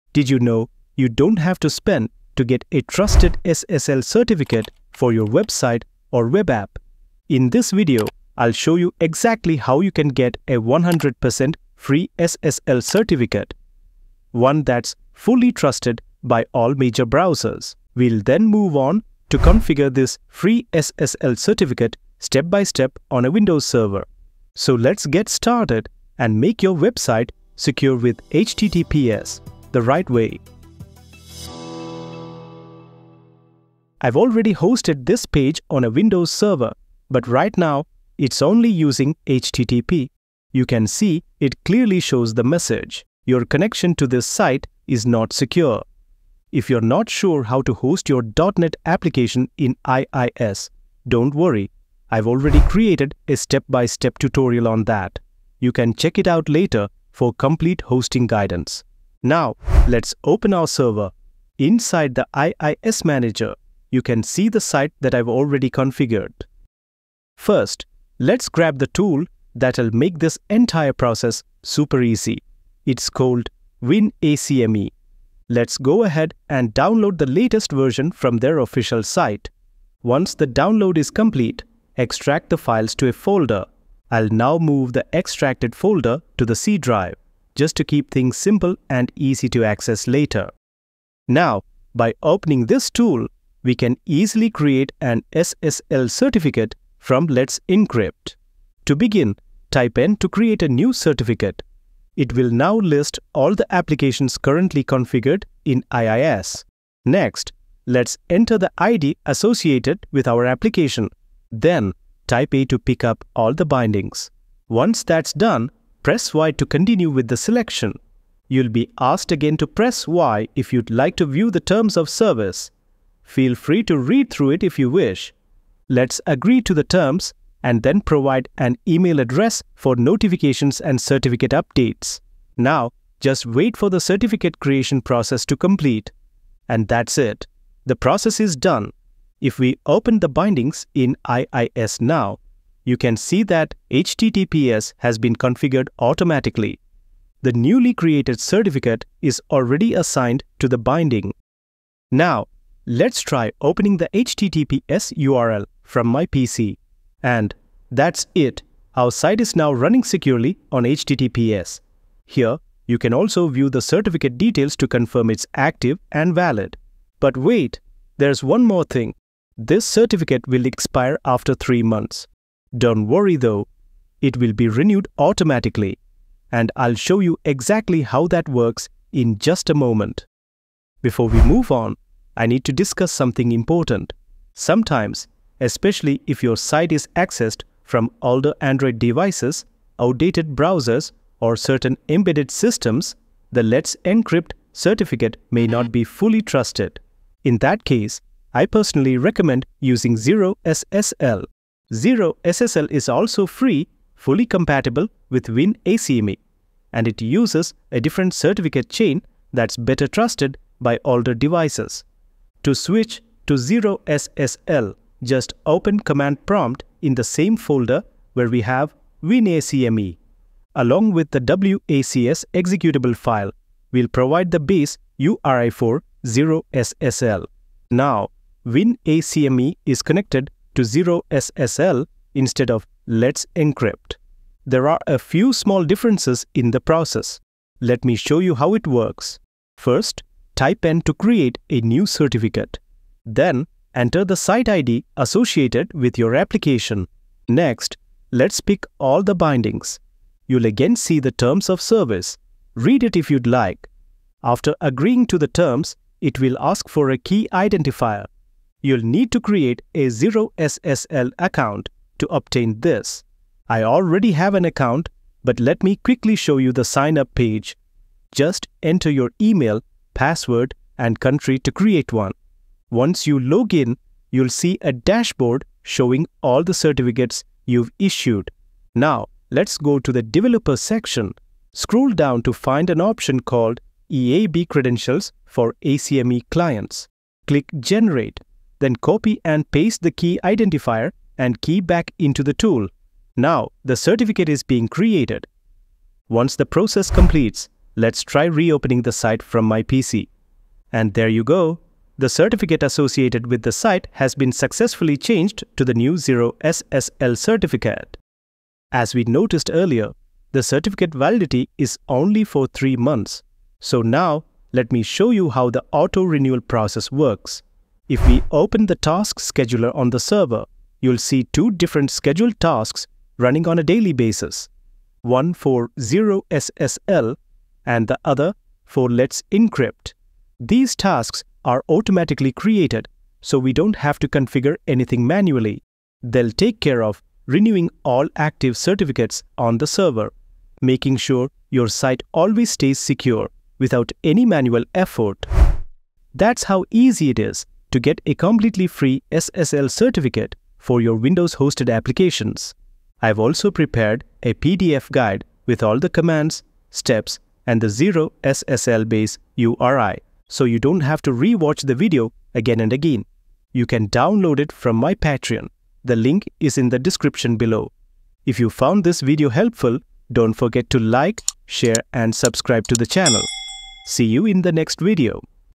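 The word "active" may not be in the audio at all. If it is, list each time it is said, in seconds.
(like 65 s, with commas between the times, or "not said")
165 s, 338 s.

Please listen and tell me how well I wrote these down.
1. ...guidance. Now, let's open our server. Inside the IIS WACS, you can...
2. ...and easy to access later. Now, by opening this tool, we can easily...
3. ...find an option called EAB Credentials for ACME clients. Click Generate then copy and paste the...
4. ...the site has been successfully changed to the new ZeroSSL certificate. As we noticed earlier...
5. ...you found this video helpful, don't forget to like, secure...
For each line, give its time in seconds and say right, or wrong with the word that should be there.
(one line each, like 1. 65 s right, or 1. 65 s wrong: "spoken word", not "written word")
1. 58 s wrong: "Manager", not "WACS"
2. 88 s right
3. 282 s right
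4. 303 s right
5. 368 s wrong: "share", not "secure".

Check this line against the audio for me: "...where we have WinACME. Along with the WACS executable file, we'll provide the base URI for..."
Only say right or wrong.
right.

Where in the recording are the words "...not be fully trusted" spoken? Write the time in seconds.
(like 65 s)
195 s.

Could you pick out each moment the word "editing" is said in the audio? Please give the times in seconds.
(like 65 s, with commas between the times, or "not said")
not said.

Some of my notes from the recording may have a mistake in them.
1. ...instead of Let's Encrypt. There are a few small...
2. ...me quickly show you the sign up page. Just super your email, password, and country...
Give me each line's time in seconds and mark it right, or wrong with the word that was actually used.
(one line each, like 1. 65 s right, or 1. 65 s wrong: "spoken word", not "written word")
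1. 232 s right
2. 265 s wrong: "enter", not "super".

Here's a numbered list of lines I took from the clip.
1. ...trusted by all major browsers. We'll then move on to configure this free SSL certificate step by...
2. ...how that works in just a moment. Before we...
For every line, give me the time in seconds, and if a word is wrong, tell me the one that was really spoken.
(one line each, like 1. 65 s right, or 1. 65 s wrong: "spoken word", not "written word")
1. 15 s right
2. 178 s right.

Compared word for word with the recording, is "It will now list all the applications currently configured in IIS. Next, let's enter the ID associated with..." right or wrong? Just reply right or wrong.
right.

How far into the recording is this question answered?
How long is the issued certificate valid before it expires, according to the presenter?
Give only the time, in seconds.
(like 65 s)
171 s.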